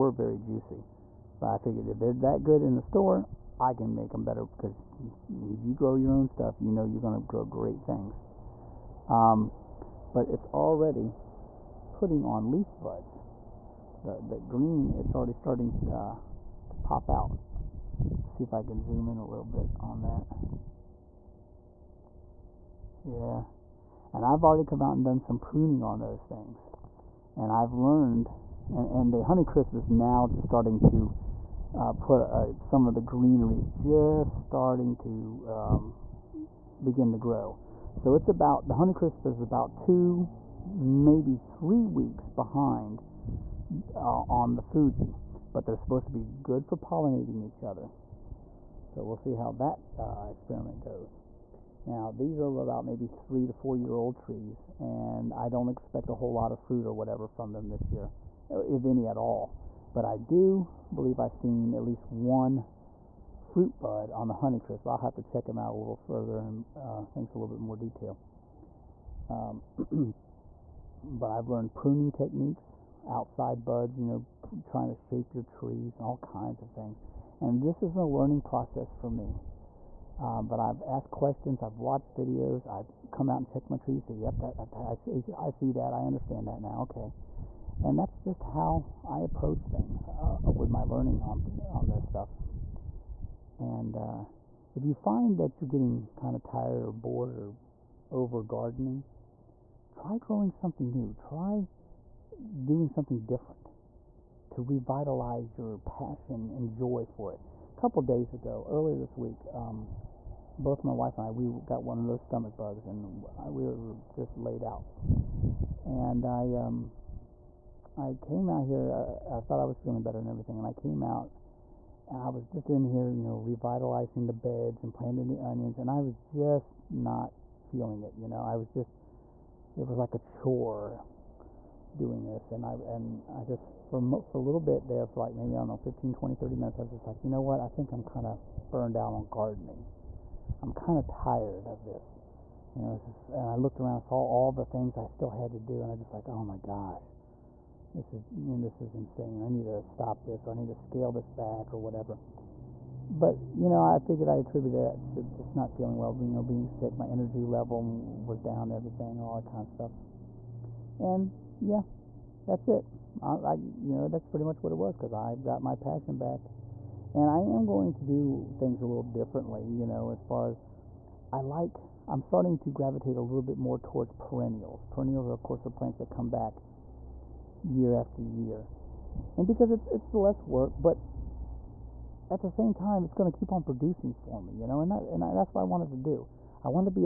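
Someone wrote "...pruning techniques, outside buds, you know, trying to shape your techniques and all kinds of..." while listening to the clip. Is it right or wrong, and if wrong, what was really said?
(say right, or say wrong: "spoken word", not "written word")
wrong: "trees", not "techniques".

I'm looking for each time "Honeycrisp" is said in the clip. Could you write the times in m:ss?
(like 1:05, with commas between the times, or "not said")
0:29, 0:38, 1:04.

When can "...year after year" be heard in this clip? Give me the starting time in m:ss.
2:57.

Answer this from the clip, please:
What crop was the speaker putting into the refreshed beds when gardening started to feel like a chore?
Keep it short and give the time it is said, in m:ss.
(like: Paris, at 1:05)
onions, at 2:05.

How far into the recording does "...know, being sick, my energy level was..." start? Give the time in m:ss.
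2:36.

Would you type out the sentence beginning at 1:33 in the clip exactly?
And uh, if you find that you're getting kind of tired or bored or over gardening, try growing something new.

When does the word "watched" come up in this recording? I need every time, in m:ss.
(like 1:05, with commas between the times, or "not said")
1:21.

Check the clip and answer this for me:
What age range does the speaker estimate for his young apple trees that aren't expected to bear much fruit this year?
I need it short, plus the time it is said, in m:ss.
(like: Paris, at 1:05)
3 to 4 years, at 0:53.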